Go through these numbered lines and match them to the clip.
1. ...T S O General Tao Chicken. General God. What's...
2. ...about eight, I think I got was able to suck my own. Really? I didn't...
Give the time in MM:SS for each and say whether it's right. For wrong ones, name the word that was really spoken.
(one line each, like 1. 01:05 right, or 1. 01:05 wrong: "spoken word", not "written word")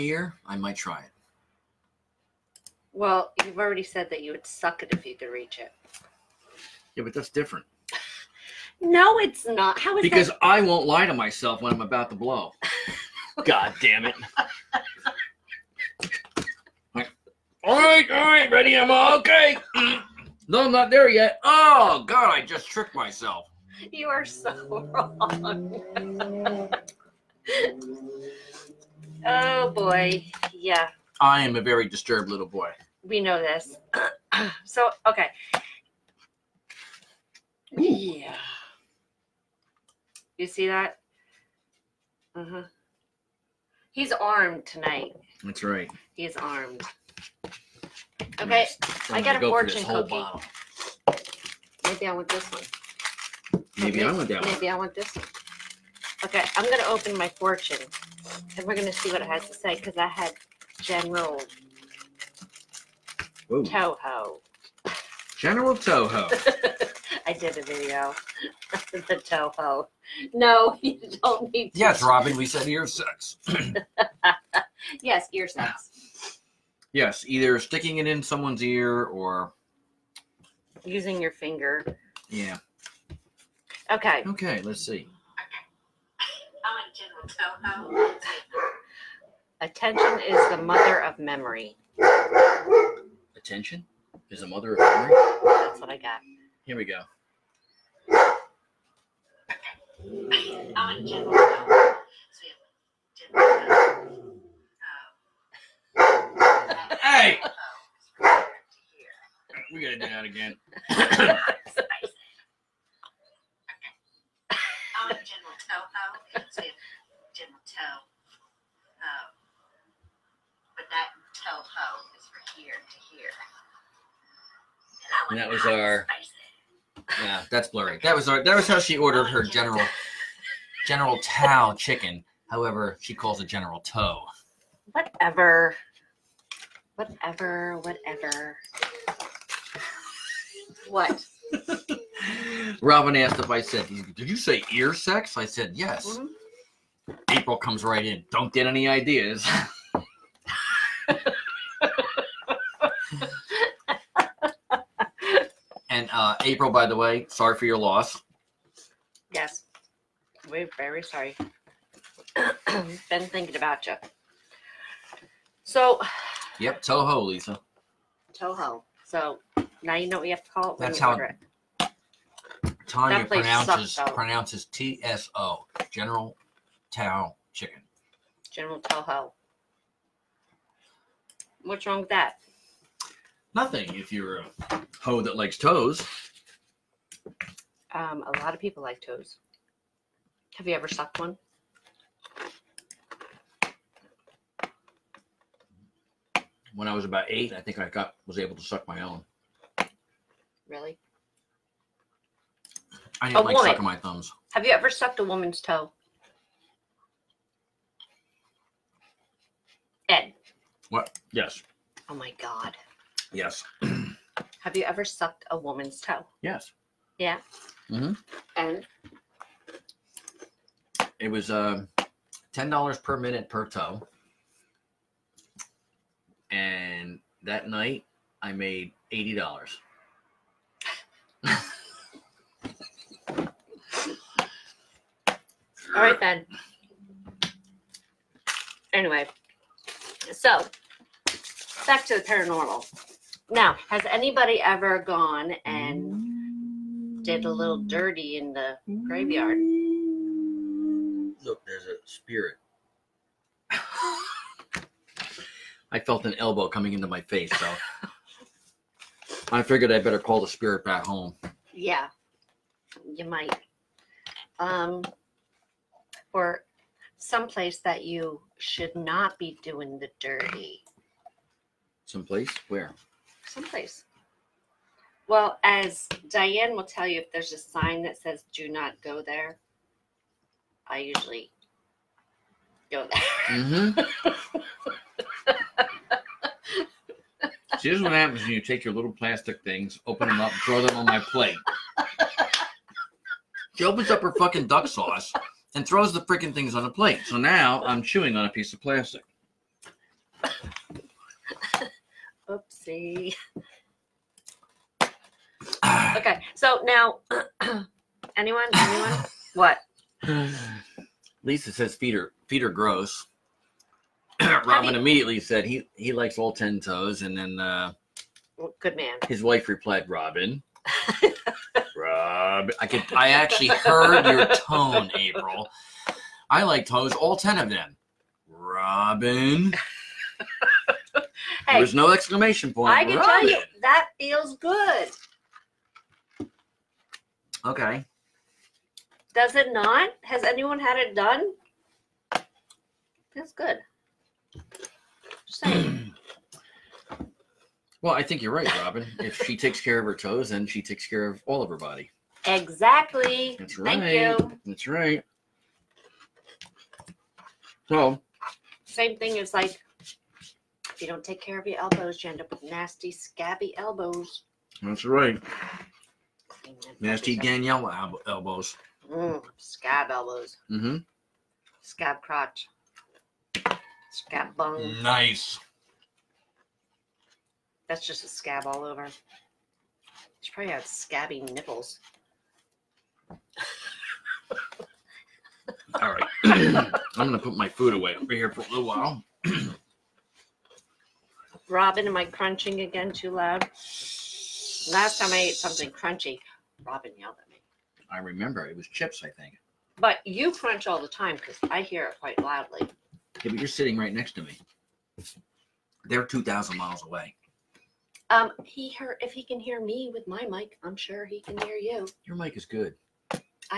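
1. 02:54 wrong: "Toho", not "God"
2. 03:17 right.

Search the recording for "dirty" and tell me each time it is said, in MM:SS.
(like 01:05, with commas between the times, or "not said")
04:07, 04:30.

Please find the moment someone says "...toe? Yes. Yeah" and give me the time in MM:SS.
03:35.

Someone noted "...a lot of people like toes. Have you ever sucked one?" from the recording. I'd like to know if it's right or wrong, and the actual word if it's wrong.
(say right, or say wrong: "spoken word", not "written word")
right.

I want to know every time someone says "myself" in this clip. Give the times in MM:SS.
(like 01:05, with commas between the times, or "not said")
00:11, 00:22.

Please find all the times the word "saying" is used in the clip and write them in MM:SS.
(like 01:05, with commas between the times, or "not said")
05:45.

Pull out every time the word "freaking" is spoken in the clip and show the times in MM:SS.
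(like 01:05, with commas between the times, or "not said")
04:56.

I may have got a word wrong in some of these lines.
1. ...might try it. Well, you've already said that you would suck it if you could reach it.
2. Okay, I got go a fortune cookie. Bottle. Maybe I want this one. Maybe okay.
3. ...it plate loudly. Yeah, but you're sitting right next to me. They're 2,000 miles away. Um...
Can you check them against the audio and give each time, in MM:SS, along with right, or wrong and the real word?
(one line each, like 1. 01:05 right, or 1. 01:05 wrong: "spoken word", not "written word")
1. 00:00 right
2. 00:48 right
3. 06:42 wrong: "quite", not "plate".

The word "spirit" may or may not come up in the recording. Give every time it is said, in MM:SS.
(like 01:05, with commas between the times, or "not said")
04:12, 04:20.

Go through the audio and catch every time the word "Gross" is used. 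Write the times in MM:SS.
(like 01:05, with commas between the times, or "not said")
05:12.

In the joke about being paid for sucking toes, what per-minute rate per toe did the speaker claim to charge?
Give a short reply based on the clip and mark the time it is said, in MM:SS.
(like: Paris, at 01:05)
$10, at 03:42.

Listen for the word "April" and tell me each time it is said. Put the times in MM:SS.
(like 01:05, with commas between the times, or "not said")
02:27, 02:36, 05:25.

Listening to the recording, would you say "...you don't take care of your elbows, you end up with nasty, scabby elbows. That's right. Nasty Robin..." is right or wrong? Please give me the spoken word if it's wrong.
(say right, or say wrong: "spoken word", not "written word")
wrong: "Danielle", not "Robin".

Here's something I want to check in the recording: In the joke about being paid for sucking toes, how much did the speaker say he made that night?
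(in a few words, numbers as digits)
$80.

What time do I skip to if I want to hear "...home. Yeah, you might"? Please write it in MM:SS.
04:21.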